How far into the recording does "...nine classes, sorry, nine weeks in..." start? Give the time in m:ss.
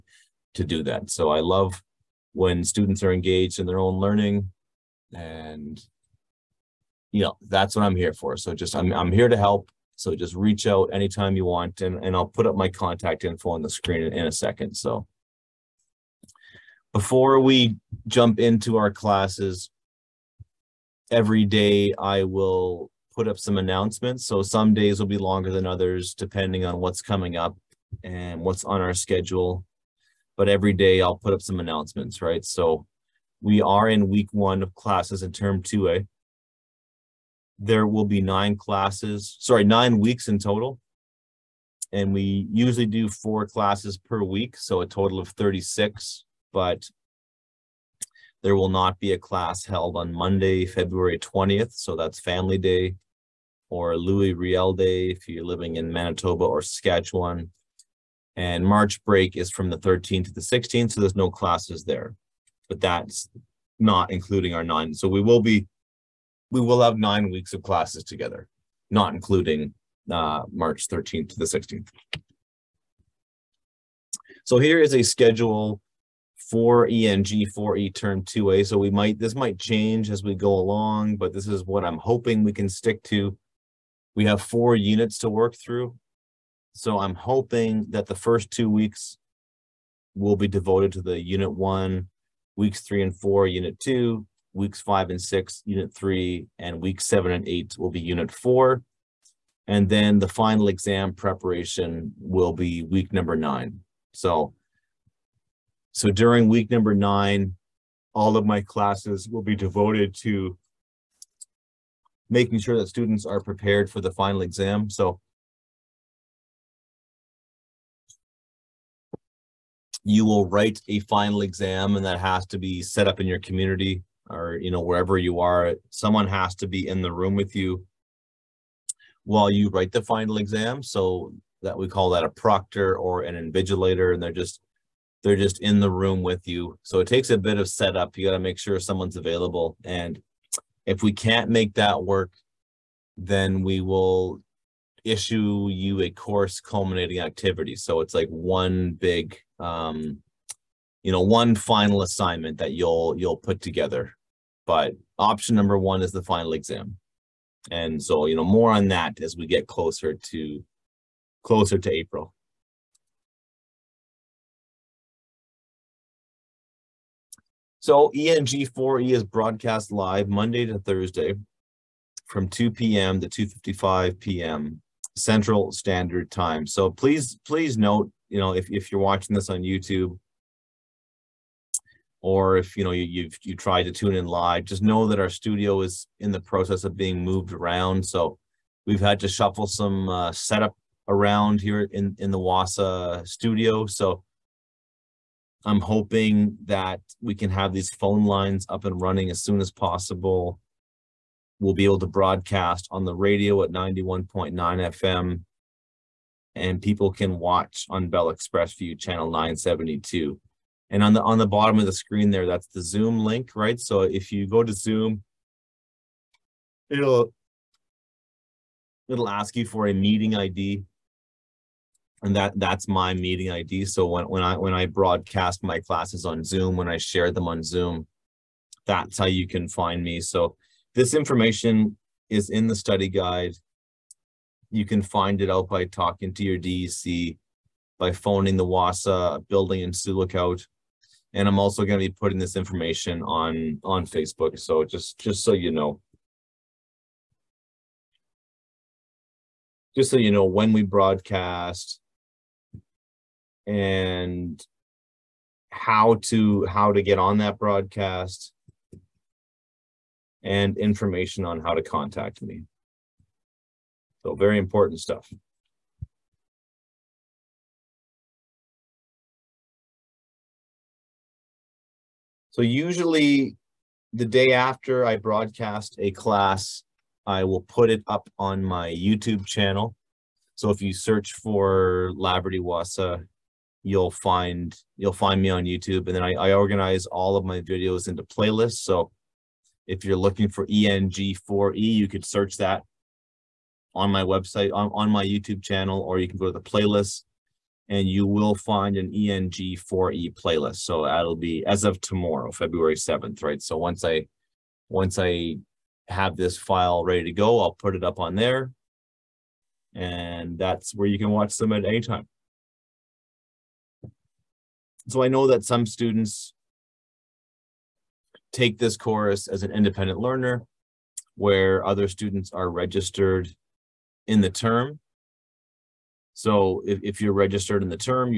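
0:38.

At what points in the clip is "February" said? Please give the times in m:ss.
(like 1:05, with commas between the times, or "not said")
0:50, 5:02.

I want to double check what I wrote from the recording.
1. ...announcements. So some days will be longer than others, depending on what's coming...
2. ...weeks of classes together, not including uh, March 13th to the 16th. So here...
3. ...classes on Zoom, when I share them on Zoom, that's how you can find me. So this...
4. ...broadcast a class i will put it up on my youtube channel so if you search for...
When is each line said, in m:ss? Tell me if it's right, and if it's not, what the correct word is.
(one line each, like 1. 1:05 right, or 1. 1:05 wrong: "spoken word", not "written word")
1. 0:23 right
2. 1:07 right
3. 3:45 right
4. 4:35 right.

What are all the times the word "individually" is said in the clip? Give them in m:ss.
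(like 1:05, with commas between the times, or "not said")
not said.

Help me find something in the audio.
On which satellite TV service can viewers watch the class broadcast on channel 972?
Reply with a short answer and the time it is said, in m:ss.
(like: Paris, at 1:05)
Bell ExpressVu, at 3:28.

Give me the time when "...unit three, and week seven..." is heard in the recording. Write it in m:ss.
1:35.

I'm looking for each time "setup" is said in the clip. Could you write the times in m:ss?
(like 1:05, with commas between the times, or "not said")
2:17, 3:10.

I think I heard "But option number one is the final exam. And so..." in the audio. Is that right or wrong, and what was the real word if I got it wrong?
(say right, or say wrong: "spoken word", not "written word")
right.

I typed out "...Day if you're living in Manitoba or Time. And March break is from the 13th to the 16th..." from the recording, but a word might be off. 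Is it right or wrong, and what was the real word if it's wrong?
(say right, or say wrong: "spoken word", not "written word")
wrong: "Saskatchewan", not "Time".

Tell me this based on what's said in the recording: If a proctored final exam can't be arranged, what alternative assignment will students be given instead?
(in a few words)
course culminating activity.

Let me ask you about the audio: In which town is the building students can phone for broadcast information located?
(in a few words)
Sioux Lookout.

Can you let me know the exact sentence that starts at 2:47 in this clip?
So ENG4E is broadcast live Monday to Thursday from 2 p.m.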